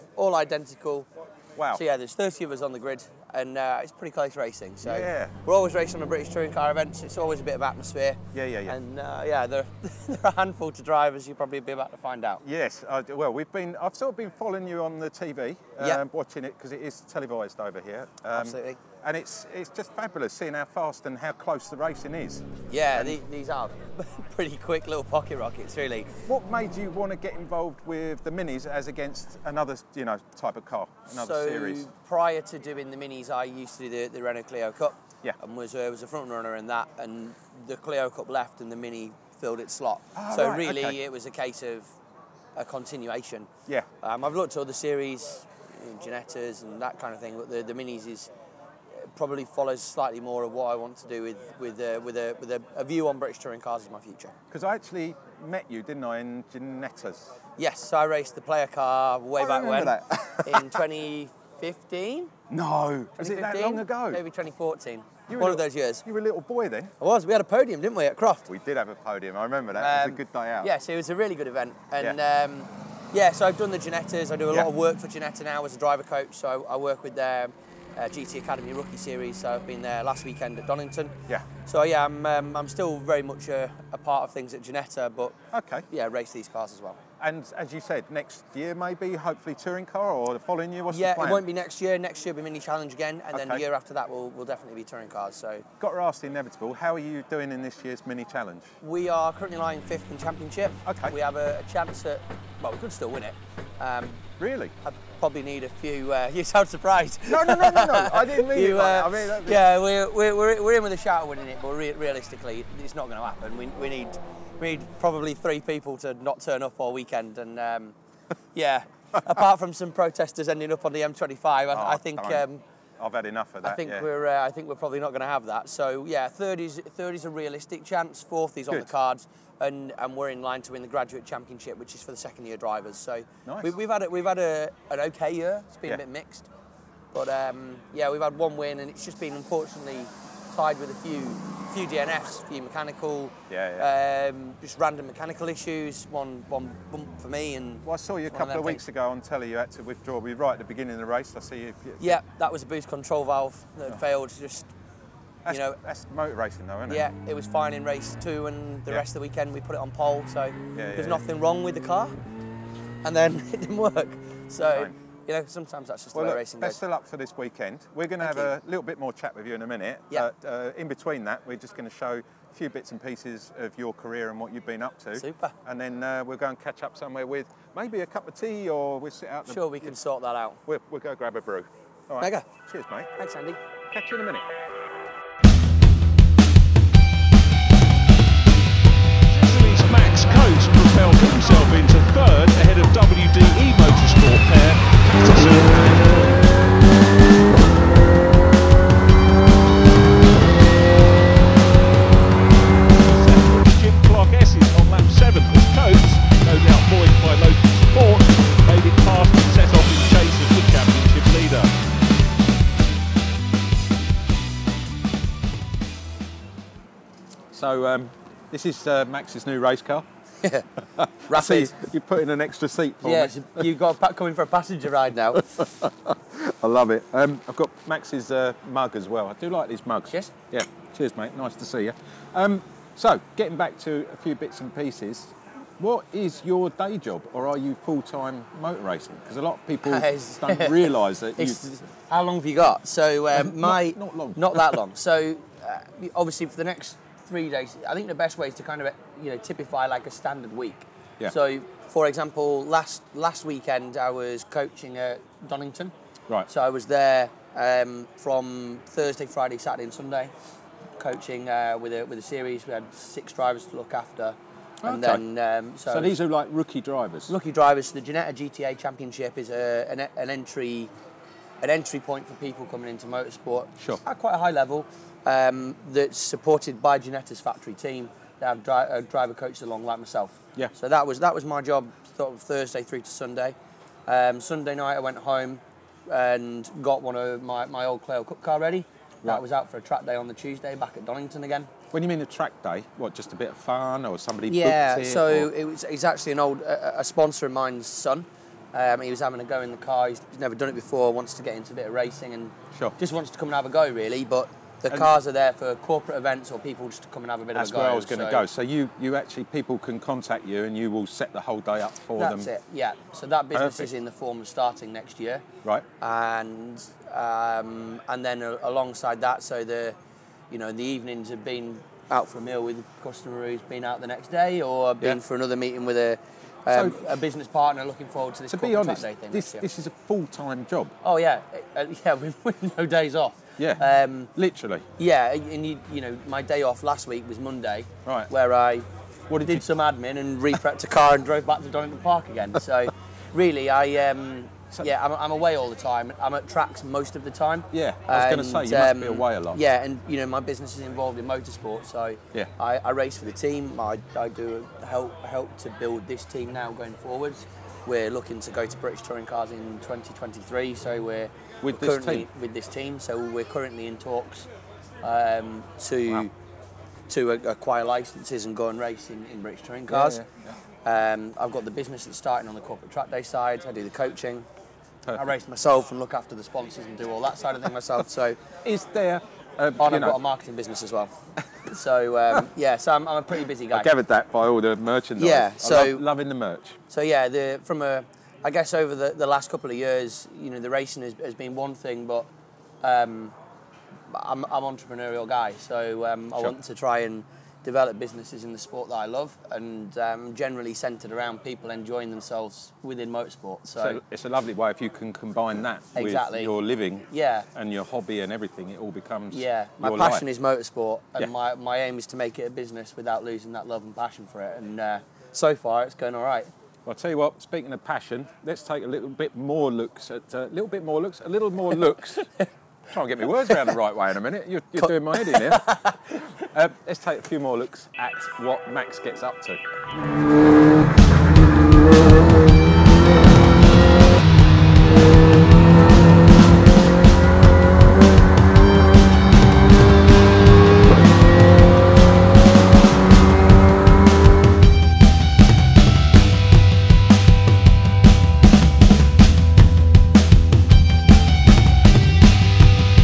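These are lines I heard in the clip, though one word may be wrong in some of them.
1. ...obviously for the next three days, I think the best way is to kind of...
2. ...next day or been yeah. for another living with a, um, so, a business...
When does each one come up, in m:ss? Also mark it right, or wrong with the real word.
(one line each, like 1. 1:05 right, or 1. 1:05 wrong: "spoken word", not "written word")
1. 4:06 right
2. 5:24 wrong: "meeting", not "living".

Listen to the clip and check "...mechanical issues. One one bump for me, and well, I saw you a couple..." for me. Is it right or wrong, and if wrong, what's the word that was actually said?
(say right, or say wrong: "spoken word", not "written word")
right.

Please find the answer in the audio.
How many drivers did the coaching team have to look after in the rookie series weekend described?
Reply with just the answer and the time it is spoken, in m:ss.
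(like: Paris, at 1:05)
6, at 4:22.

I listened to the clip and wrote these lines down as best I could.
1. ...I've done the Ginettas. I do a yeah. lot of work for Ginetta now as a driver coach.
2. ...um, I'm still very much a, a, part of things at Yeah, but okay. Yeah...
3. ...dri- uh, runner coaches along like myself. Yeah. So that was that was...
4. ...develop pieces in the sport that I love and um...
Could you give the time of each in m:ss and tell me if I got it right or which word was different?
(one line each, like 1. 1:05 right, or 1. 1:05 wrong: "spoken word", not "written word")
1. 1:13 right
2. 1:22 wrong: "Ginetta", not "Yeah"
3. 4:38 wrong: "driver", not "runner"
4. 6:37 wrong: "businesses", not "pieces".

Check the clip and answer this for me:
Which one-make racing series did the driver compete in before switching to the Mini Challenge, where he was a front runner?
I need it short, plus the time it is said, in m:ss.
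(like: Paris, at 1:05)
Renault Clio Cup, at 0:34.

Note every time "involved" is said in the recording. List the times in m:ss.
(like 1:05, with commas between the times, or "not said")
0:27, 5:50.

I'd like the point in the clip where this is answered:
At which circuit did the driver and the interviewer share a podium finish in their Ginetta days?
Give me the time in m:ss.
1:08.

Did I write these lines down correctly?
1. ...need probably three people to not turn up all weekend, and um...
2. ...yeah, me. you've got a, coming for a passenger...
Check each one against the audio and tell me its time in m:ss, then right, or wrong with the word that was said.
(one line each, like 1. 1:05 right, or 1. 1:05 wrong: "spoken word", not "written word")
1. 1:54 right
2. 3:43 right.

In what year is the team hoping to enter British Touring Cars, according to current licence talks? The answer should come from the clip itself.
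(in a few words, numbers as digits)
2023.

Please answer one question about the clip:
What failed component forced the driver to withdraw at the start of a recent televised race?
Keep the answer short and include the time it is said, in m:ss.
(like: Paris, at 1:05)
Boost control valve, at 2:32.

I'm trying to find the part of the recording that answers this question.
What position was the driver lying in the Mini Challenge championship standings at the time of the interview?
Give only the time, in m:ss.
1:39.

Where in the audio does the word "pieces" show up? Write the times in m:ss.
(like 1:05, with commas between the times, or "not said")
2:53, 3:54.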